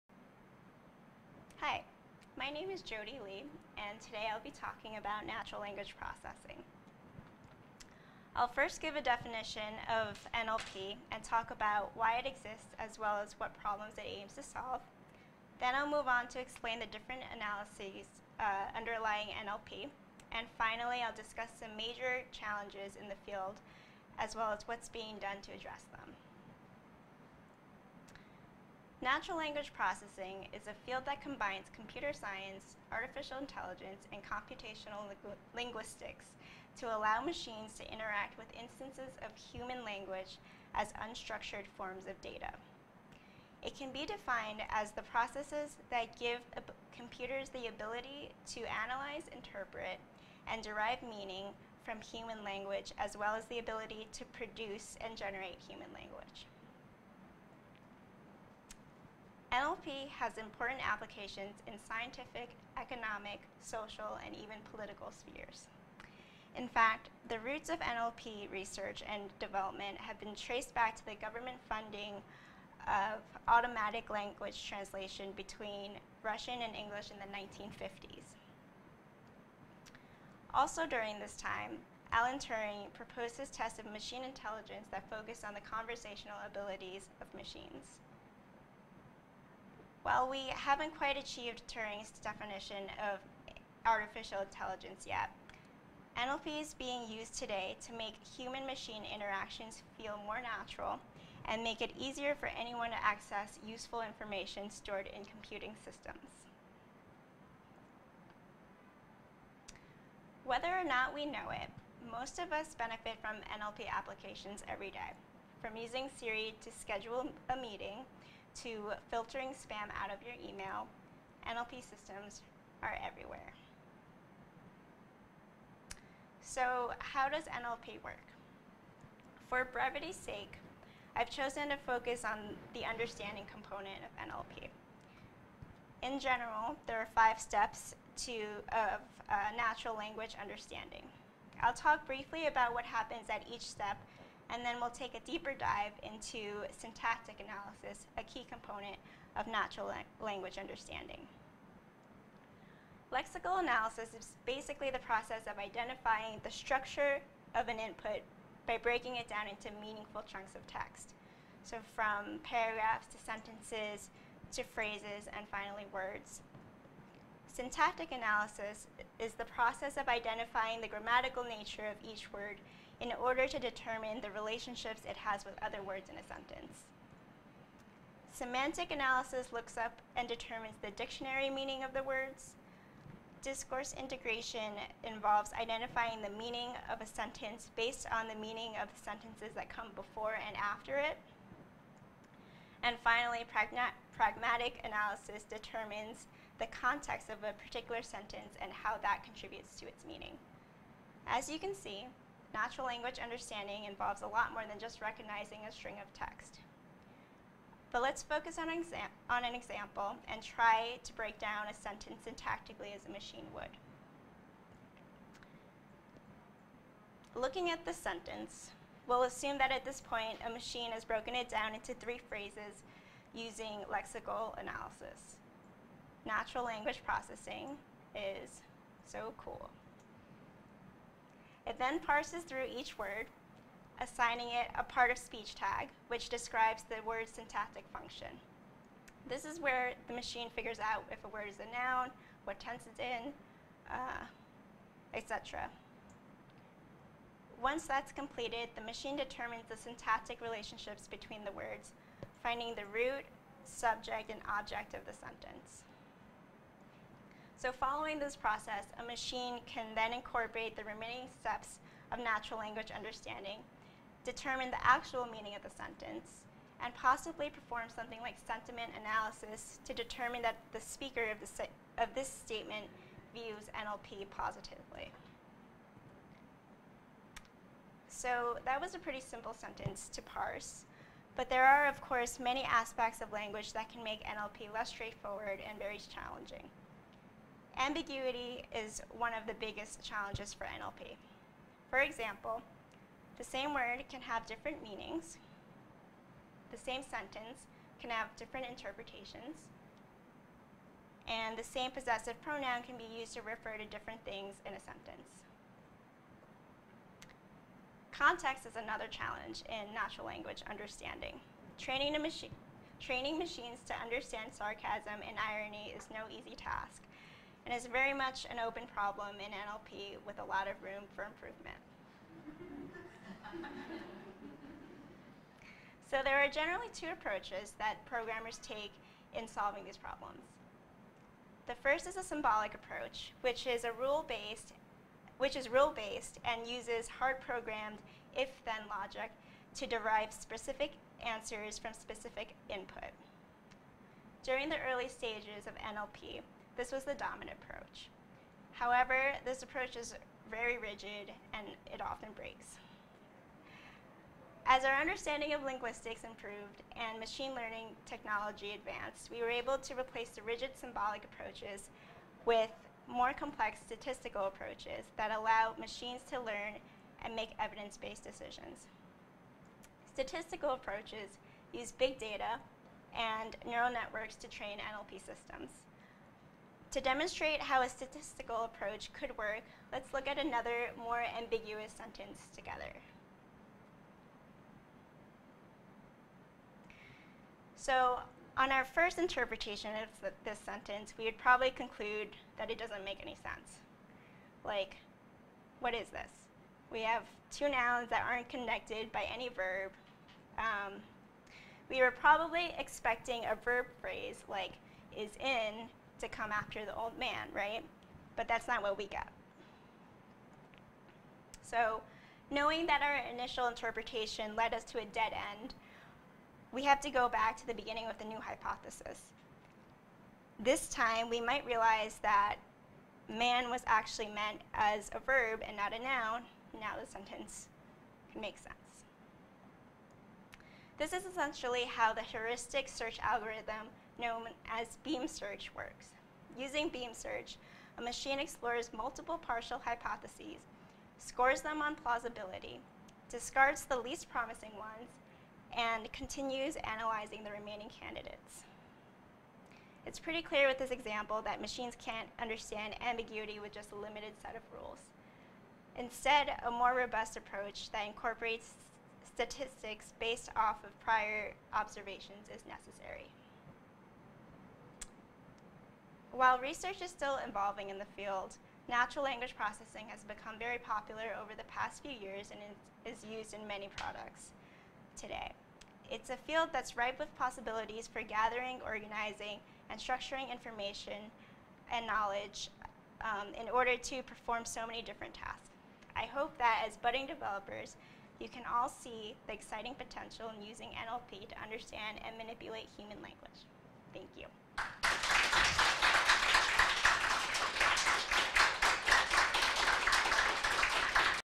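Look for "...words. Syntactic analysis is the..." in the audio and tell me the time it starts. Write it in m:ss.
2:45.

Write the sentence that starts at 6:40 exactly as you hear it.
Um, we were probably expecting a verb phrase like is in to come after the old man, right?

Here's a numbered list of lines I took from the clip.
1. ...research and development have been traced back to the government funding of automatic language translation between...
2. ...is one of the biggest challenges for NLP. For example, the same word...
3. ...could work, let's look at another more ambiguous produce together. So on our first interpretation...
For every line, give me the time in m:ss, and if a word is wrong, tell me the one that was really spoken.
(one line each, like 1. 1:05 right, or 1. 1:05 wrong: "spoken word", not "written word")
1. 1:08 right
2. 4:48 right
3. 6:19 wrong: "sentence", not "produce".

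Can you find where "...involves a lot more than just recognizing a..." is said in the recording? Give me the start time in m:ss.
3:23.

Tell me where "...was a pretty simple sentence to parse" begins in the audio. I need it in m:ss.
4:38.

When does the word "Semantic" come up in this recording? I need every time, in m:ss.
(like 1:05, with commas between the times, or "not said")
2:58.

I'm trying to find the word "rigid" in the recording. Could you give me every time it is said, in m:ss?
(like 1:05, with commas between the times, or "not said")
5:50, 6:00.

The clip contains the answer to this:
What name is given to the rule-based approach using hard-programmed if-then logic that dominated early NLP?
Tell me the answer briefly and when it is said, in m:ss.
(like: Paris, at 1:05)
Symbolic approach, at 5:32.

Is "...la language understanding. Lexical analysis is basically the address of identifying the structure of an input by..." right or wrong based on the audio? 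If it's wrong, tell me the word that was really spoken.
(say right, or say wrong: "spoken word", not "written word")
wrong: "process", not "address".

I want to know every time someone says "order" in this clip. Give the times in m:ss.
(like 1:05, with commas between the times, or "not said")
2:53, 8:03.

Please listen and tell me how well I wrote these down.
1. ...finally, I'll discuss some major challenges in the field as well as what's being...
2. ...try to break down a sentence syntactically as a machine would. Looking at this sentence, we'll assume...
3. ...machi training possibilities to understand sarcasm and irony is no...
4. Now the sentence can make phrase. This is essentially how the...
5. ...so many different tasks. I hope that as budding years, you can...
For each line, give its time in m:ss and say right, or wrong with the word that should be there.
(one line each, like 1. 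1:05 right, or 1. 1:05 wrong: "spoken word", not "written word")
1. 0:20 right
2. 3:30 right
3. 5:12 wrong: "machines", not "possibilities"
4. 7:06 wrong: "sense", not "phrase"
5. 8:04 wrong: "developers", not "years".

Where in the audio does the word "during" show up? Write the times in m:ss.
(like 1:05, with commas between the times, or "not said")
1:20, 5:44.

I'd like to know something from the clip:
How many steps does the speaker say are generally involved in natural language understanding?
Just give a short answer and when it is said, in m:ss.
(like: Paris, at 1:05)
5, at 2:17.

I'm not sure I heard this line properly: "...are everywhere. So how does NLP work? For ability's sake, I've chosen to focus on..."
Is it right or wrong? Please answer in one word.
wrong.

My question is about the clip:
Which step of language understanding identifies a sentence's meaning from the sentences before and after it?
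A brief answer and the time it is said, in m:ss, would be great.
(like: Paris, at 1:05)
Discourse integration, at 3:03.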